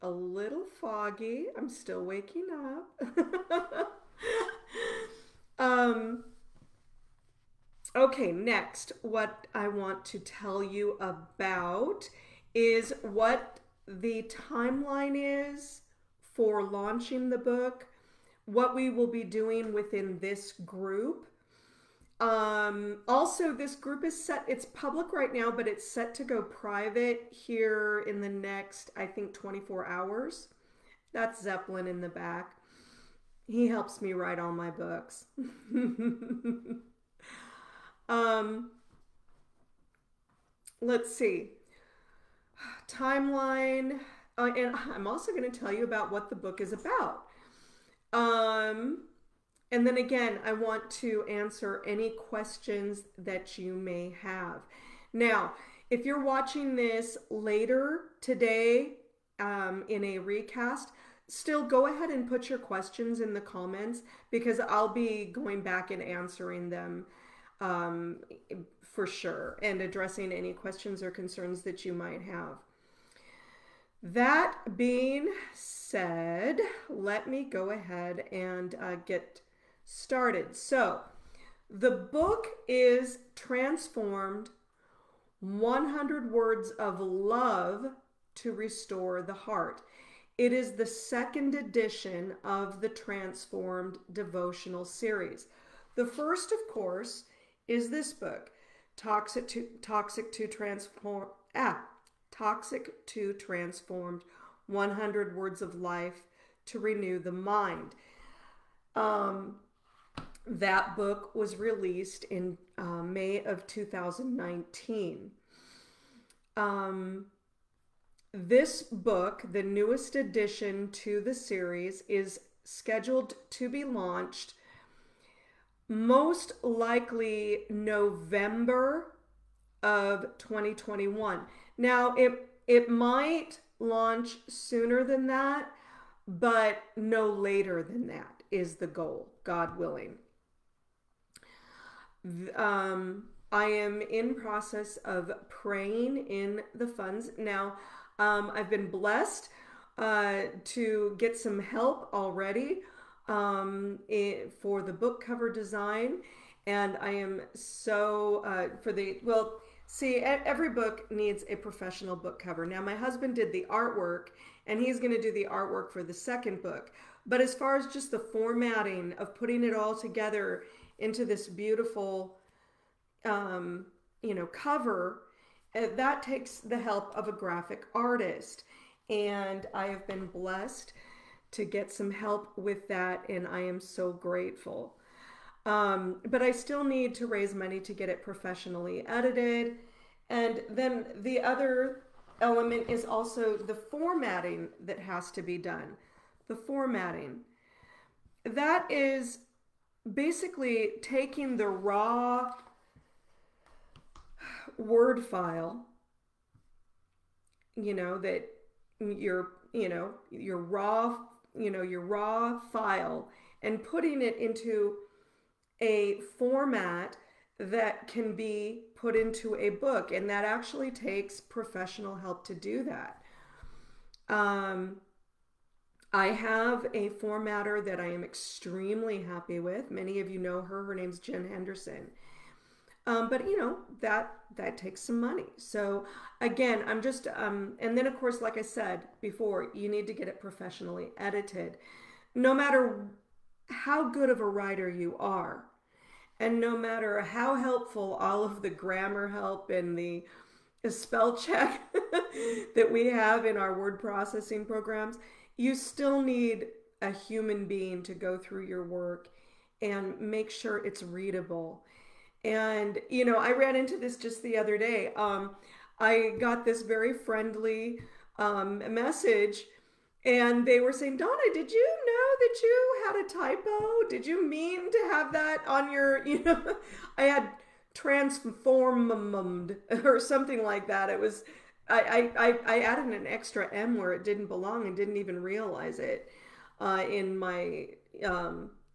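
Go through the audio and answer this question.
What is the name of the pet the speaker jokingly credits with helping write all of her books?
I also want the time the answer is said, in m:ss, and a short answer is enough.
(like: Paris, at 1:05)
Zeppelin, at 0:31.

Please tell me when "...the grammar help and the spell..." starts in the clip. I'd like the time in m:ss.
4:08.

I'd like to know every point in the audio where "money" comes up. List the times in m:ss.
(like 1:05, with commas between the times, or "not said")
3:07, 3:55.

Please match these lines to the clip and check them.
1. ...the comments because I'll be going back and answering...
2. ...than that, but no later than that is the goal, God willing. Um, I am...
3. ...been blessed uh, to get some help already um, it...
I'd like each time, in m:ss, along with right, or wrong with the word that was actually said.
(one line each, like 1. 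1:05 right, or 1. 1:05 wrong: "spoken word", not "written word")
1. 1:03 right
2. 2:15 right
3. 2:28 right.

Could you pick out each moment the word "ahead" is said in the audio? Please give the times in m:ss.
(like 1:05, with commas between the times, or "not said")
1:01, 1:17.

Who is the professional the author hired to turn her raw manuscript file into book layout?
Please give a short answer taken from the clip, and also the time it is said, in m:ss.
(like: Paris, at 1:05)
Jen Henderson, at 3:51.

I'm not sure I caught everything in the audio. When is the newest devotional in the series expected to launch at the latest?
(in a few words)
November 2021.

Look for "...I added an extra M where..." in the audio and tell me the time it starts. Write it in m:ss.
4:42.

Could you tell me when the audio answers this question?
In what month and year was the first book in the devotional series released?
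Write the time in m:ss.
1:53.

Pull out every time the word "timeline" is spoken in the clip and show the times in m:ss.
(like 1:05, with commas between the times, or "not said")
0:14, 0:42.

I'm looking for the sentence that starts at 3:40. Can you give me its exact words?
And that actually takes professional help to do that.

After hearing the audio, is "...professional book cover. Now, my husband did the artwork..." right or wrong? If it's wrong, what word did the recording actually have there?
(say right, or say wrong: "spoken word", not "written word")
right.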